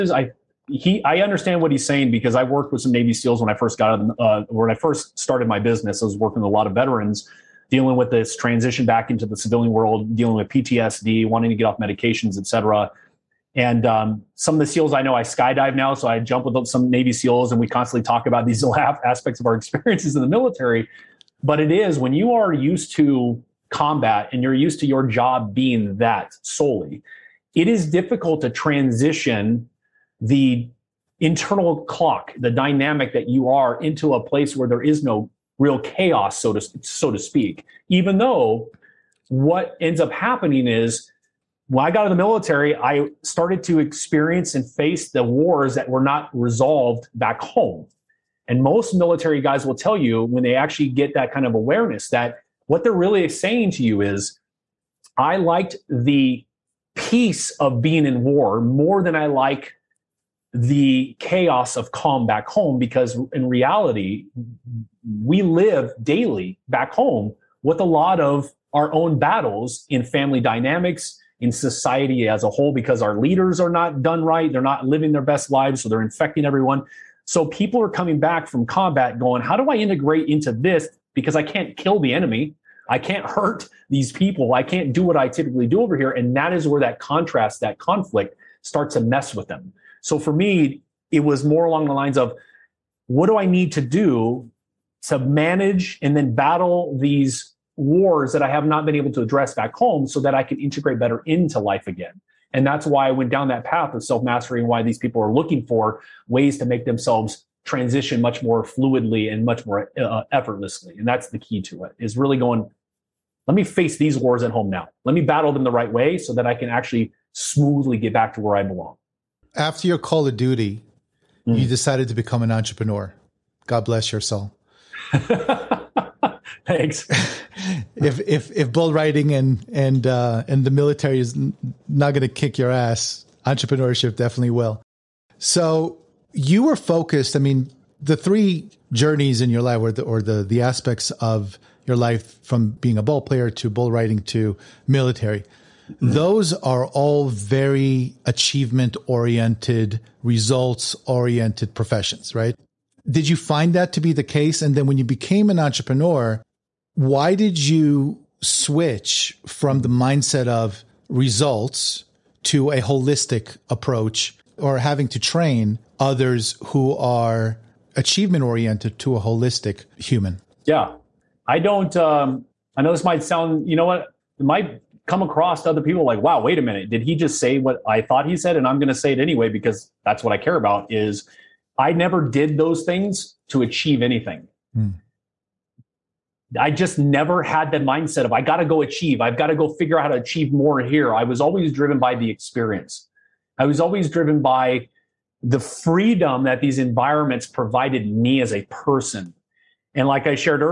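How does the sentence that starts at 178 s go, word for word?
And I'm going to say it anyway because that's what I care about.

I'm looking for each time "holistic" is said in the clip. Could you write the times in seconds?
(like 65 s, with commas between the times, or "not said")
162 s, 169 s.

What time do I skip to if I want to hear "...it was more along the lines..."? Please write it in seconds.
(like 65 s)
91 s.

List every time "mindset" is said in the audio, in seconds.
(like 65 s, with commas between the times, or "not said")
159 s, 187 s.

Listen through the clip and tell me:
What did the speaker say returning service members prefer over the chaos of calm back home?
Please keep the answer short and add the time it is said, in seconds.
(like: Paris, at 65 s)
The peace of being in war, at 56 s.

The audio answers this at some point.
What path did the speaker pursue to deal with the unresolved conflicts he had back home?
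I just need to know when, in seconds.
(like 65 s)
104 s.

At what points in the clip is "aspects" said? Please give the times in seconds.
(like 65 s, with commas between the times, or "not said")
19 s, 140 s.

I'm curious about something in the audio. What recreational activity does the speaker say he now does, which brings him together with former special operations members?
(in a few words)
Skydive.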